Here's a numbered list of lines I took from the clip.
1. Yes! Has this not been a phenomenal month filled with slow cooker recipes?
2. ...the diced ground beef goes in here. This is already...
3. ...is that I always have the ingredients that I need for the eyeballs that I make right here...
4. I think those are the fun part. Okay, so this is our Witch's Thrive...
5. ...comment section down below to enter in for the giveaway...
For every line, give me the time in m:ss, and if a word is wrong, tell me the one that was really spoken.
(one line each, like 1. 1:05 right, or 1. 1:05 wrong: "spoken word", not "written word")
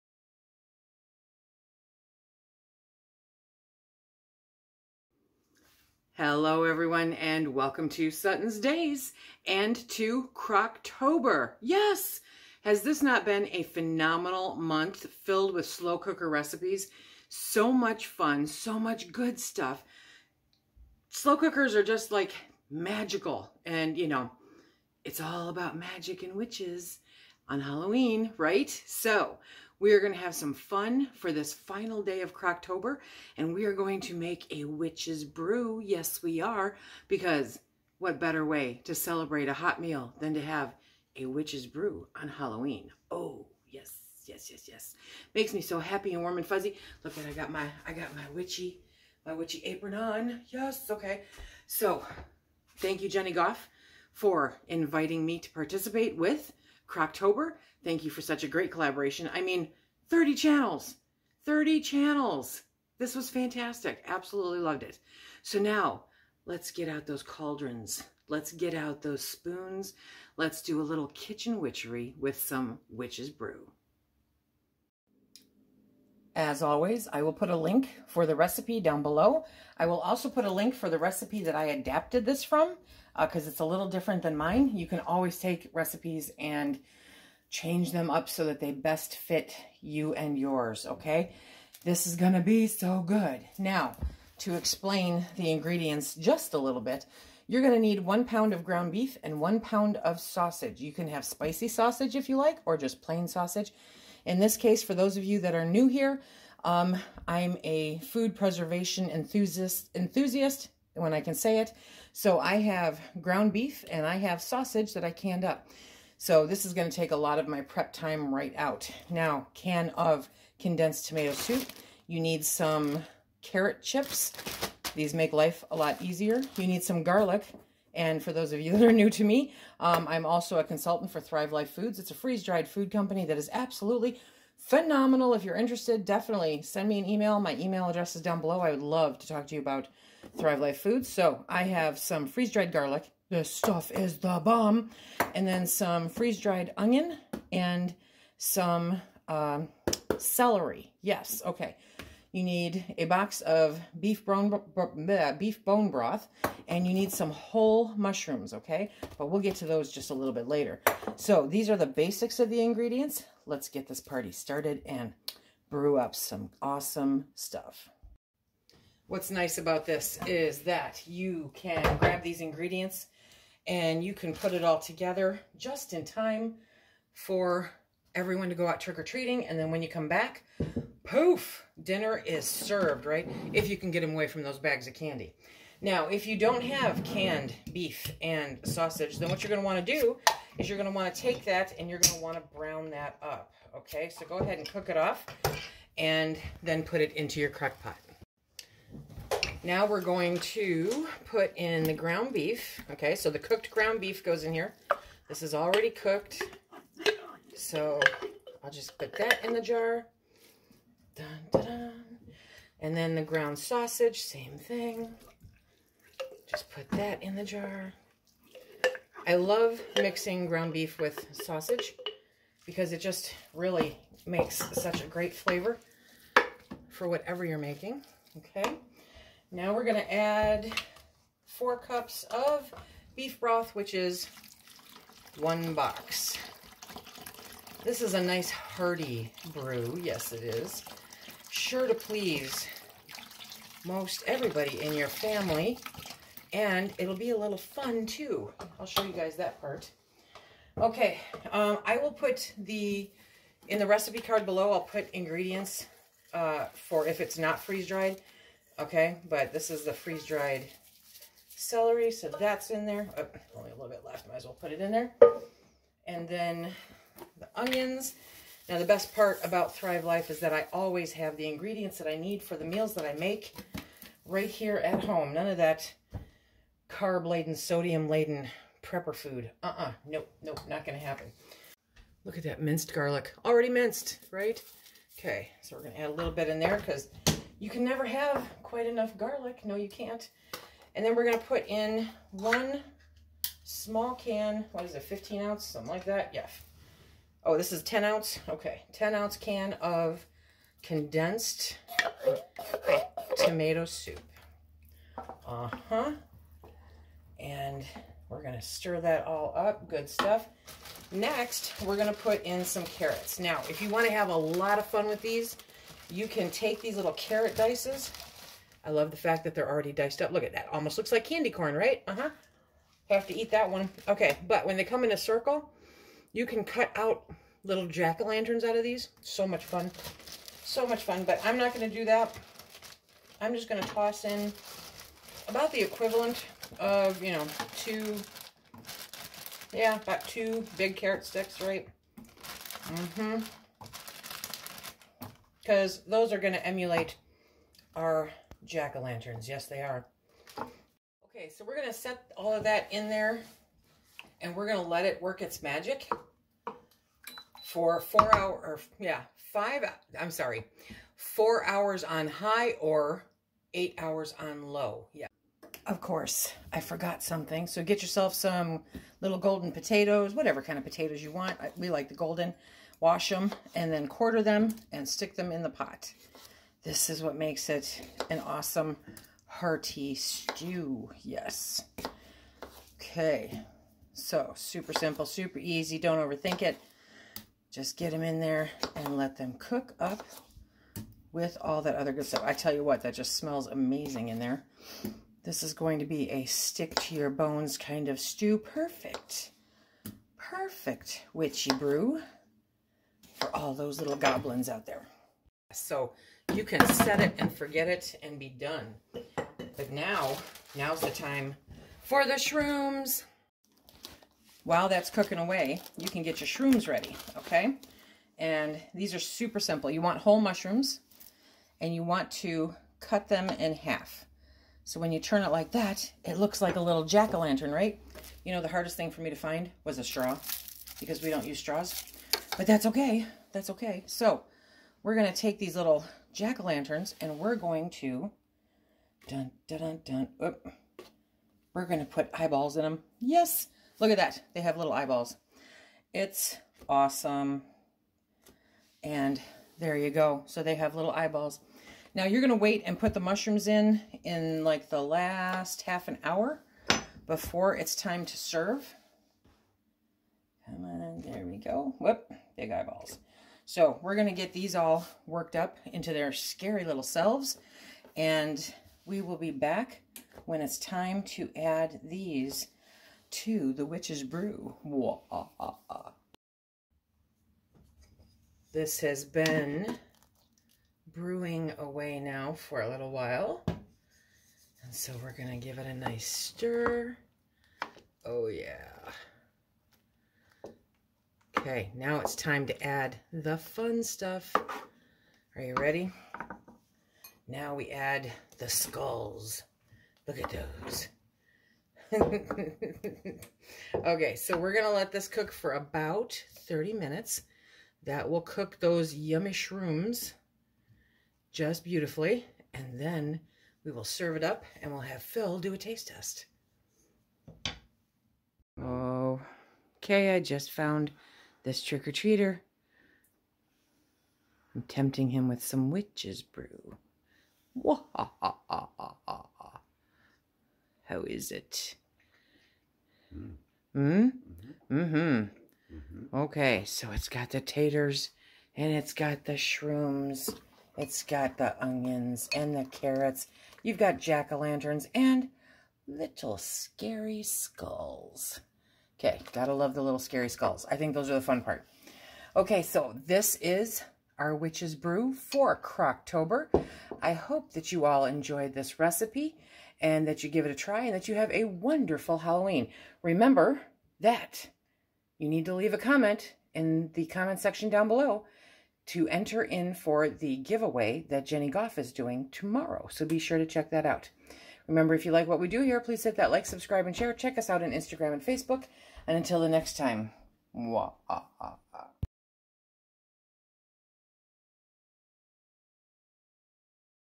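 1. 0:11 right
2. 3:23 wrong: "cooked", not "diced"
3. 4:30 wrong: "meals", not "eyeballs"
4. 9:10 wrong: "Brew", not "Thrive"
5. 9:27 right.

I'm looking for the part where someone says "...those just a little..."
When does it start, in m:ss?
2:39.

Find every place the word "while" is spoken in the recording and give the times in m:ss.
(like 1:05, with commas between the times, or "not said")
6:54, 8:03.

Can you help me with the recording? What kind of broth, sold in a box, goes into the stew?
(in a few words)
beef bone broth.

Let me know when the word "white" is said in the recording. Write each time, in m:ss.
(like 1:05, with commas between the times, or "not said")
not said.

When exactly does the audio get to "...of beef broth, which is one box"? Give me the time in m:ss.
3:52.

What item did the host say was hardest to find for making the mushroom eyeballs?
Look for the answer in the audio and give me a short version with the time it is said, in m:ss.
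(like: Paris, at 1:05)
a straw, at 7:09.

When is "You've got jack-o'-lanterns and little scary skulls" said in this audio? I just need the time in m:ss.
9:03.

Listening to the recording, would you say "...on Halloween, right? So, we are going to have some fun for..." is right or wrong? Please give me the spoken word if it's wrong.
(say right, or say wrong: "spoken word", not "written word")
right.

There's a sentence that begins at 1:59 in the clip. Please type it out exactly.
Now, can of condensed tomato soup.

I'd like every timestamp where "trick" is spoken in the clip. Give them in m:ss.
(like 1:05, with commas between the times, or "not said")
2:58, 8:41.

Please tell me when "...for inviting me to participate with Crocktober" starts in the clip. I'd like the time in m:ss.
0:54.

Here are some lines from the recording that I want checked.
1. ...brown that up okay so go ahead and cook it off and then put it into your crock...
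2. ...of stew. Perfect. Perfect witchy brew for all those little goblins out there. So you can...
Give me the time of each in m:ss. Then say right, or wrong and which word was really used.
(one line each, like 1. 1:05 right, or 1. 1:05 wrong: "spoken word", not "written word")
1. 3:12 right
2. 6:38 right.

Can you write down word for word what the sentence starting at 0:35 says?
Yes, we are, because what better way to celebrate a hot meal than to have a witch's brew on Halloween?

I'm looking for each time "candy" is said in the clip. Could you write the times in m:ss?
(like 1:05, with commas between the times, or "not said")
3:04, 5:21.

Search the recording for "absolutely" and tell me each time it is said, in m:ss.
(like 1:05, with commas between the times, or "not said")
1:04, 2:13.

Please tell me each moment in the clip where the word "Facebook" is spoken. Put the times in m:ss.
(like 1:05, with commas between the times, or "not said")
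9:38.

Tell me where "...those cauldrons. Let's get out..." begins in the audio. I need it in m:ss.
1:07.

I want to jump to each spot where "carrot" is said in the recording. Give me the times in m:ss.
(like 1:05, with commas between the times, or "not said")
2:03, 5:12, 5:17, 5:40, 9:02.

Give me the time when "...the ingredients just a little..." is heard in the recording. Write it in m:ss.
1:35.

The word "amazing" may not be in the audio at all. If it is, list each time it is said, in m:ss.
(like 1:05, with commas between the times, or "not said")
6:33.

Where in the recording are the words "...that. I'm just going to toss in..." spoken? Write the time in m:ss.
5:32.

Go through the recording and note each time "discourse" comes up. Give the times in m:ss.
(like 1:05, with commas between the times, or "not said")
not said.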